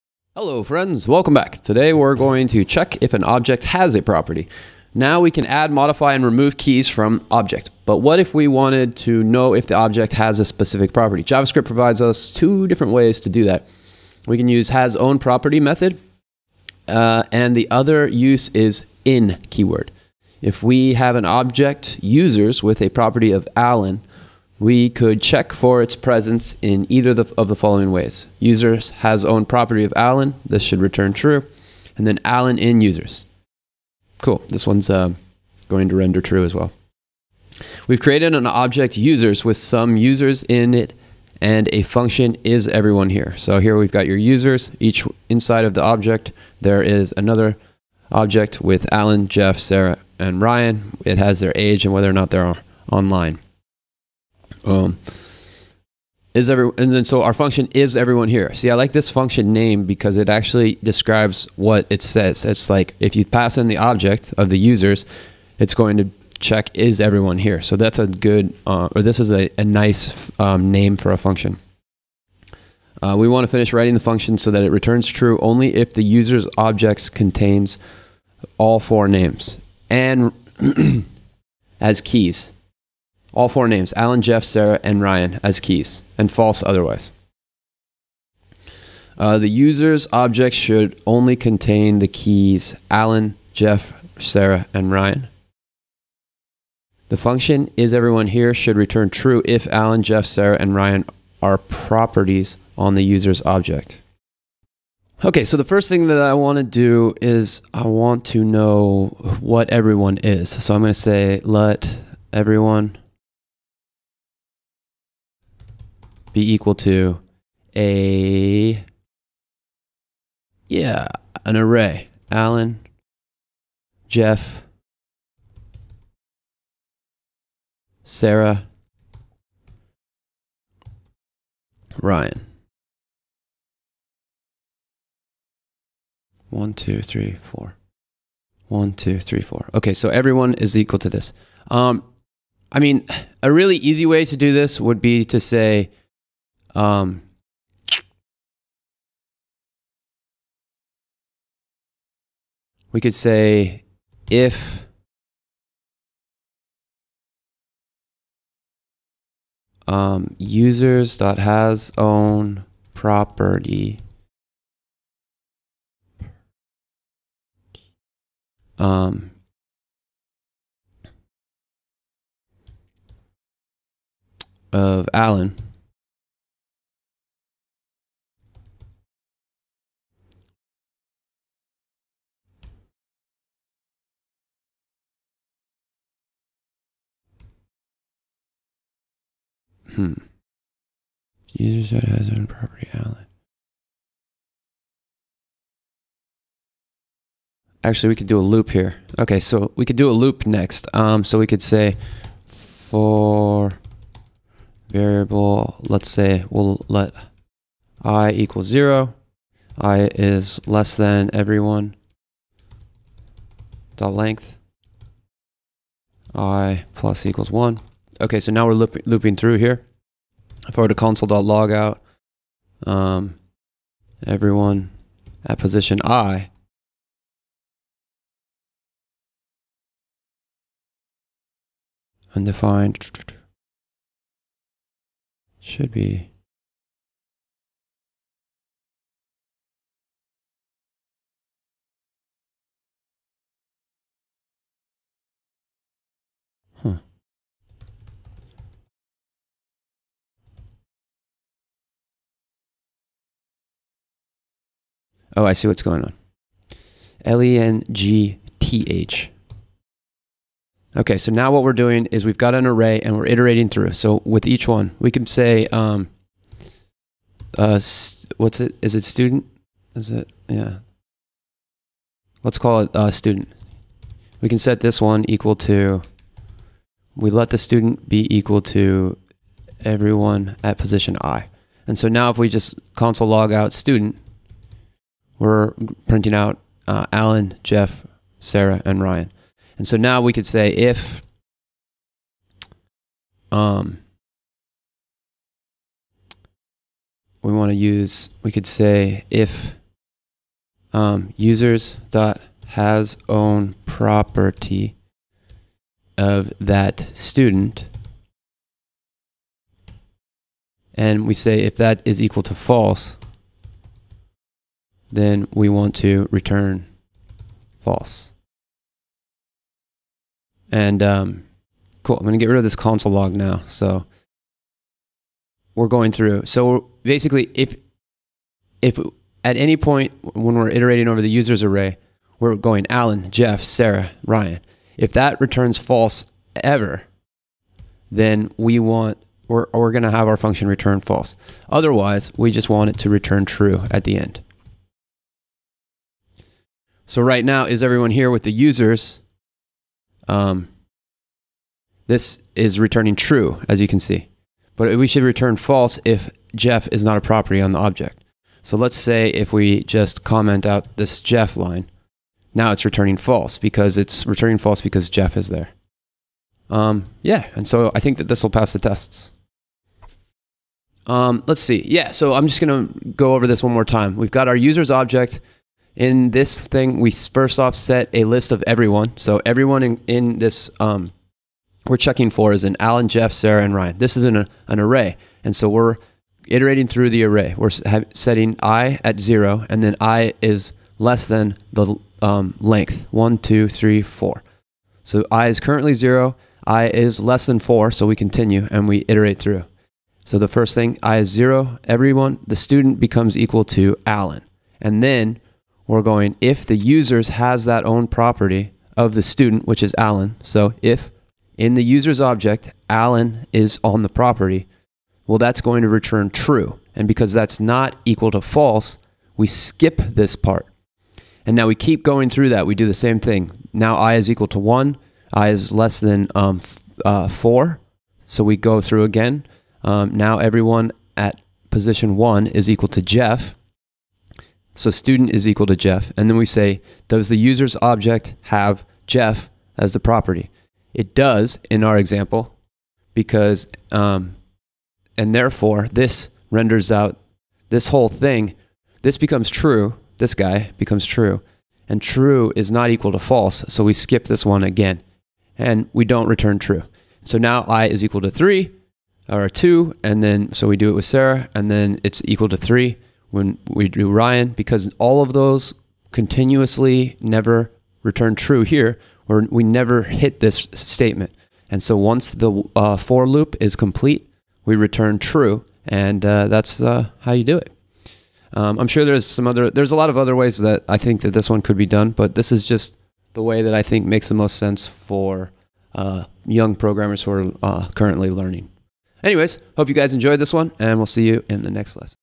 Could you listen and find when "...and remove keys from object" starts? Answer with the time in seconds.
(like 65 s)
6 s.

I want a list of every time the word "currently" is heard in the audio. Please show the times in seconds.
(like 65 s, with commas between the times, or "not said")
395 s, 487 s.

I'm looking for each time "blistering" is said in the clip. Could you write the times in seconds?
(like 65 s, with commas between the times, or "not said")
not said.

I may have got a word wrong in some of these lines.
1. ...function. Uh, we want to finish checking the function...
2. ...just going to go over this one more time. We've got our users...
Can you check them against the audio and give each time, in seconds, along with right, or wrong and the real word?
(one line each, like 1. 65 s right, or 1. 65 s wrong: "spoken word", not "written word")
1. 71 s wrong: "writing", not "checking"
2. 372 s right.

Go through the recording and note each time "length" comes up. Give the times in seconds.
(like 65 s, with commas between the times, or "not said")
214 s, 392 s.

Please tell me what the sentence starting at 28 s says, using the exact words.
Users has own property of Alan.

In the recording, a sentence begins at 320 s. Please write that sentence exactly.
And um, cool, I'm going to get rid of this console log now.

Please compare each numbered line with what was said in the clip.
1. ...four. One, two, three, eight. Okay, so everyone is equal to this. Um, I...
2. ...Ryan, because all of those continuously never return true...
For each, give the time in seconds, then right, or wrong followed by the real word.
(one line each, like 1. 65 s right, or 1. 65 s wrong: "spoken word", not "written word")
1. 137 s wrong: "four", not "eight"
2. 464 s right.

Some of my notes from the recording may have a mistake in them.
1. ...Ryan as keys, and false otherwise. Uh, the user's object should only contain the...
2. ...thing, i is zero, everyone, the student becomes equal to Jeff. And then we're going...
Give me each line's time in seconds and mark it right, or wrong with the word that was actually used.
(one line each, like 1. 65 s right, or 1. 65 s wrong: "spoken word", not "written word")
1. 85 s right
2. 400 s wrong: "Alan", not "Jeff".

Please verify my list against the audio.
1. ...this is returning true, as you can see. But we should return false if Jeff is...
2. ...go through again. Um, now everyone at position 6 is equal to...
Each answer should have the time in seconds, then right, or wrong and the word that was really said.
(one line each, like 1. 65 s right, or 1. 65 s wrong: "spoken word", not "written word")
1. 352 s right
2. 428 s wrong: "1", not "6".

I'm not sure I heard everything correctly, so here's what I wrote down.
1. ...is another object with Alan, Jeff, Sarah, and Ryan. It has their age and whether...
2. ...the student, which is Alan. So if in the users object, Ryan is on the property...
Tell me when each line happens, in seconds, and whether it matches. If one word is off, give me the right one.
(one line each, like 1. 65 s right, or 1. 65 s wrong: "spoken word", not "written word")
1. 46 s right
2. 409 s wrong: "Alan", not "Ryan".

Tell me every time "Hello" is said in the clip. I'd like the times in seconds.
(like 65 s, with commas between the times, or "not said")
0 s.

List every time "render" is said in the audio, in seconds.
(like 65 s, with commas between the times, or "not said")
35 s, 446 s.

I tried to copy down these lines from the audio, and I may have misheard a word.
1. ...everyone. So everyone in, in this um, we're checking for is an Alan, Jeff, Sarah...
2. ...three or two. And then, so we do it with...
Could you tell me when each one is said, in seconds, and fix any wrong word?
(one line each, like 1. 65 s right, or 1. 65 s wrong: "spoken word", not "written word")
1. 378 s right
2. 458 s right.